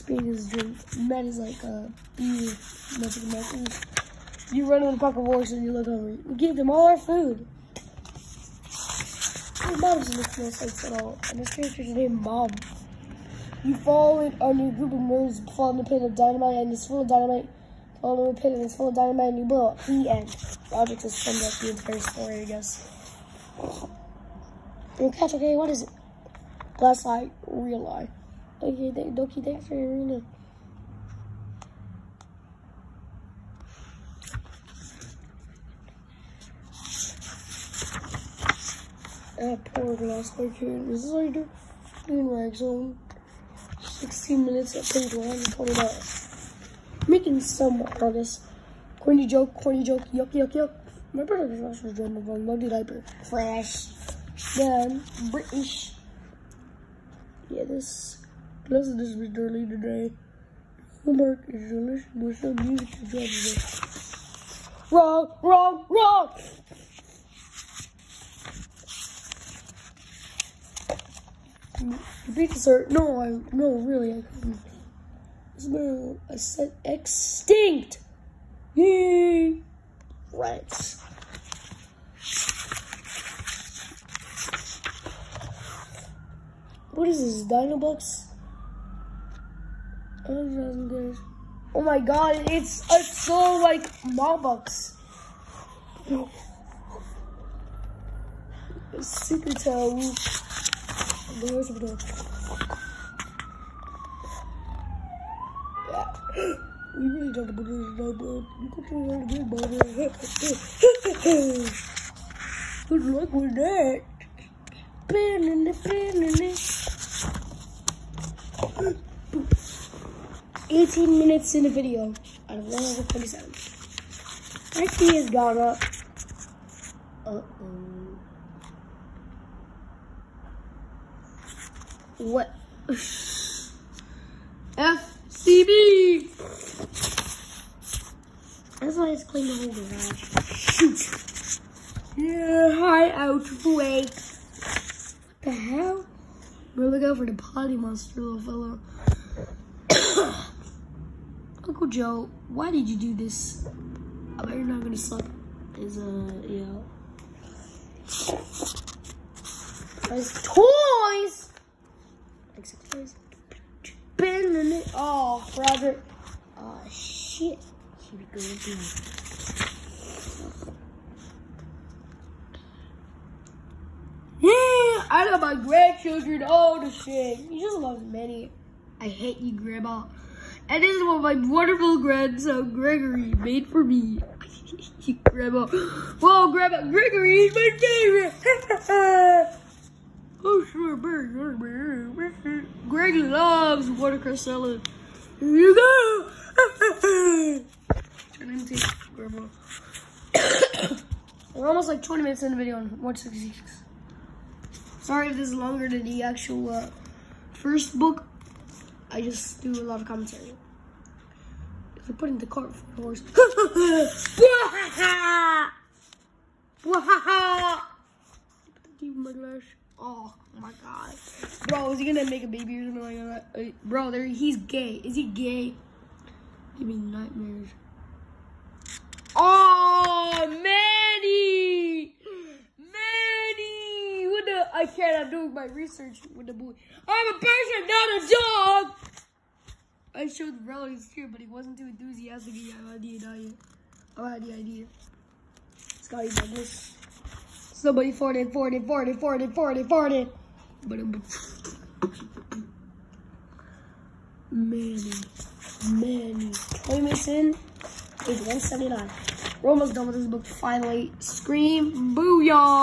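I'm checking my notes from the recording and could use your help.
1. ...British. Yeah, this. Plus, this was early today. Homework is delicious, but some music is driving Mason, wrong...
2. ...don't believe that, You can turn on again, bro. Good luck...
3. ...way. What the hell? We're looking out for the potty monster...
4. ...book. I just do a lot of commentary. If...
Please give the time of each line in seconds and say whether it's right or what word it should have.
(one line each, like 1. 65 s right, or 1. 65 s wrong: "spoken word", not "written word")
1. 55 s wrong: "Wrong", not "Mason"
2. 107 s right
3. 143 s right
4. 207 s right.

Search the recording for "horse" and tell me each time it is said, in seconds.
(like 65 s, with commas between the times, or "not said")
5 s, 213 s.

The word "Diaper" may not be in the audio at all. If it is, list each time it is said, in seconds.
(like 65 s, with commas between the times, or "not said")
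52 s.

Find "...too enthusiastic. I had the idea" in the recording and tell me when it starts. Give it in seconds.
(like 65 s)
241 s.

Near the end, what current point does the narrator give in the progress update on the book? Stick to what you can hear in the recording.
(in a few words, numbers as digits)
179.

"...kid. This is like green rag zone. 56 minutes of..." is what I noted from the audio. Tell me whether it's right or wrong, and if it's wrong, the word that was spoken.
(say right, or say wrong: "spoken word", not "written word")
wrong: "16", not "56".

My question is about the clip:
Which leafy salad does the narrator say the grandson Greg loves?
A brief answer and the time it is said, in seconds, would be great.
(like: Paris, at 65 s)
watercress salad, at 193 s.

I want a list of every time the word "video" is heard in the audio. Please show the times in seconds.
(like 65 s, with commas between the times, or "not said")
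121 s, 202 s.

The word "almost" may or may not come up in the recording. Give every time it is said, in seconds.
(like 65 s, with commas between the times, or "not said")
201 s, 259 s.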